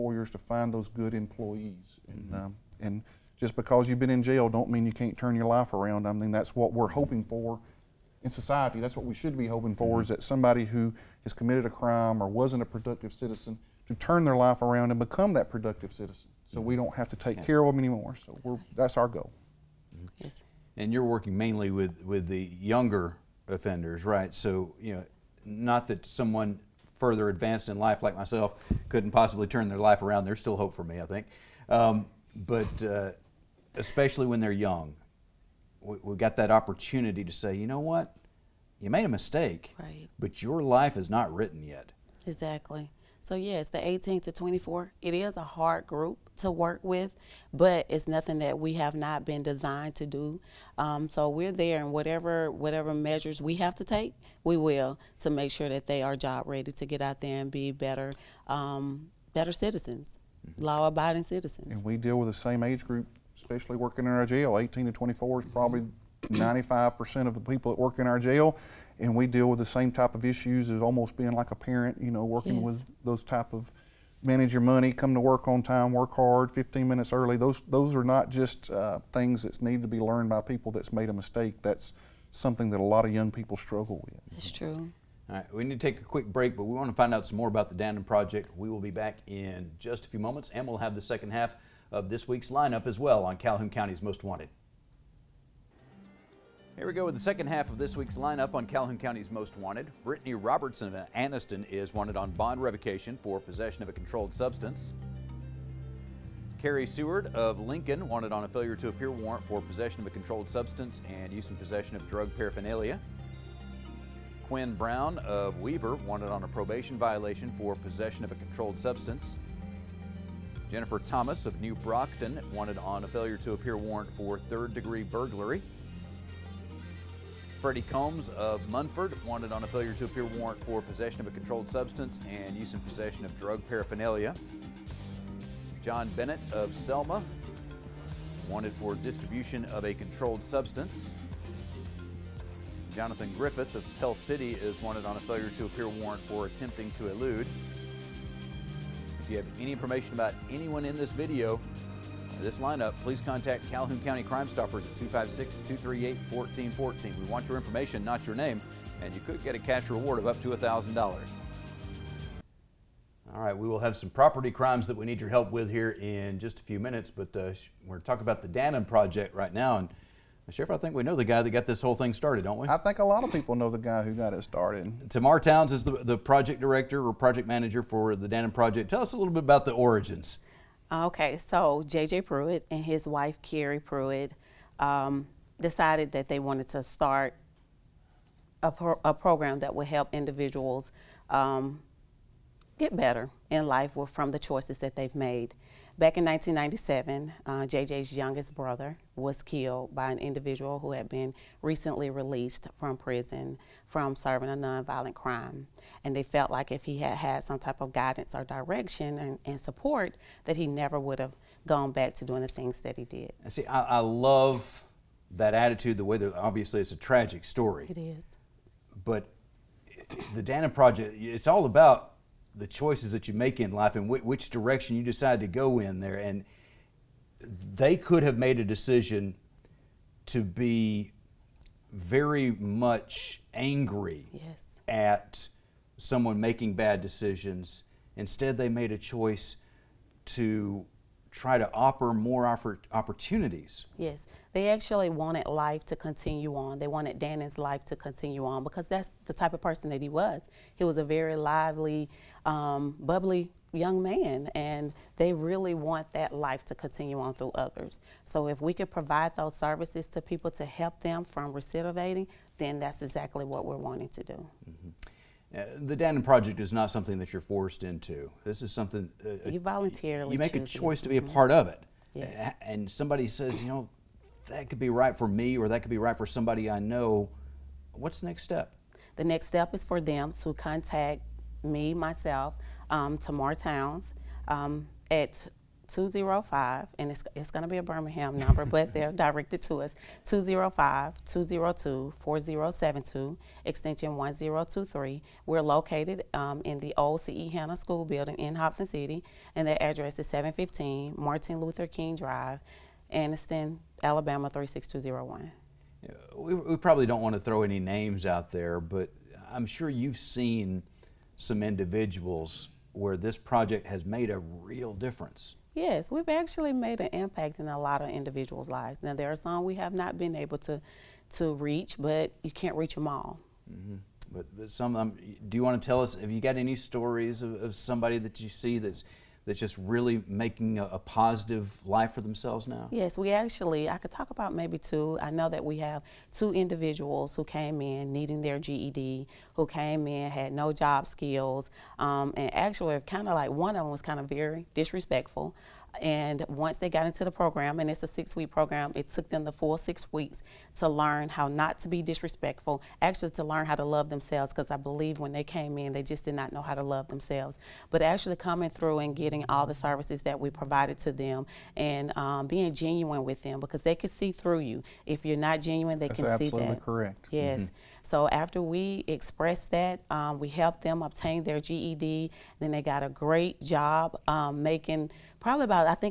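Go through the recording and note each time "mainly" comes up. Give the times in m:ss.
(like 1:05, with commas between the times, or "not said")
0:21.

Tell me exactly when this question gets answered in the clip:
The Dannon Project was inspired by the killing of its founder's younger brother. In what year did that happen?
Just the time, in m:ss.
3:16.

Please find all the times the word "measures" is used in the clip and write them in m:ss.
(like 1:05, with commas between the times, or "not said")
0:52.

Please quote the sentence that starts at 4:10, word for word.
He was a very lively, um, bubbly young man and they really want that life to continue on through others.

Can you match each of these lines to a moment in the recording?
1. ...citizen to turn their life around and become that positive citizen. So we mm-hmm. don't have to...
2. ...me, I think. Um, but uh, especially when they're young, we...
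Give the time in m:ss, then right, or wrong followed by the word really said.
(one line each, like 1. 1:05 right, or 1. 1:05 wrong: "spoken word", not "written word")
1. 0:13 wrong: "productive", not "positive"
2. 0:30 right.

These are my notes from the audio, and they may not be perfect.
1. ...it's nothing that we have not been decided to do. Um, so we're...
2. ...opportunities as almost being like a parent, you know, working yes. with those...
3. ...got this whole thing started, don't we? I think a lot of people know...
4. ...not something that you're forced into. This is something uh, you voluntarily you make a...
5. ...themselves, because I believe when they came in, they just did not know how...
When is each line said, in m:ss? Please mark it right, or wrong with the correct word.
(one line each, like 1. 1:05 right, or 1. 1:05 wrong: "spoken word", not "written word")
1. 0:47 wrong: "designed", not "decided"
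2. 1:10 wrong: "issues", not "opportunities"
3. 2:51 right
4. 4:26 right
5. 5:54 right.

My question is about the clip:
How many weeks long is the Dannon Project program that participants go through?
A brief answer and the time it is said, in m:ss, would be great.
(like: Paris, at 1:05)
6 weeks, at 5:48.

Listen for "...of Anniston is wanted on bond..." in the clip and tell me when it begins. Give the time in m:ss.
1:40.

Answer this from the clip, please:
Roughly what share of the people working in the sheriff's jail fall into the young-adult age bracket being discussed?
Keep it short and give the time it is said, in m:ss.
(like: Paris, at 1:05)
95%, at 1:06.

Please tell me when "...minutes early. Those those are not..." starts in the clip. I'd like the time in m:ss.
1:16.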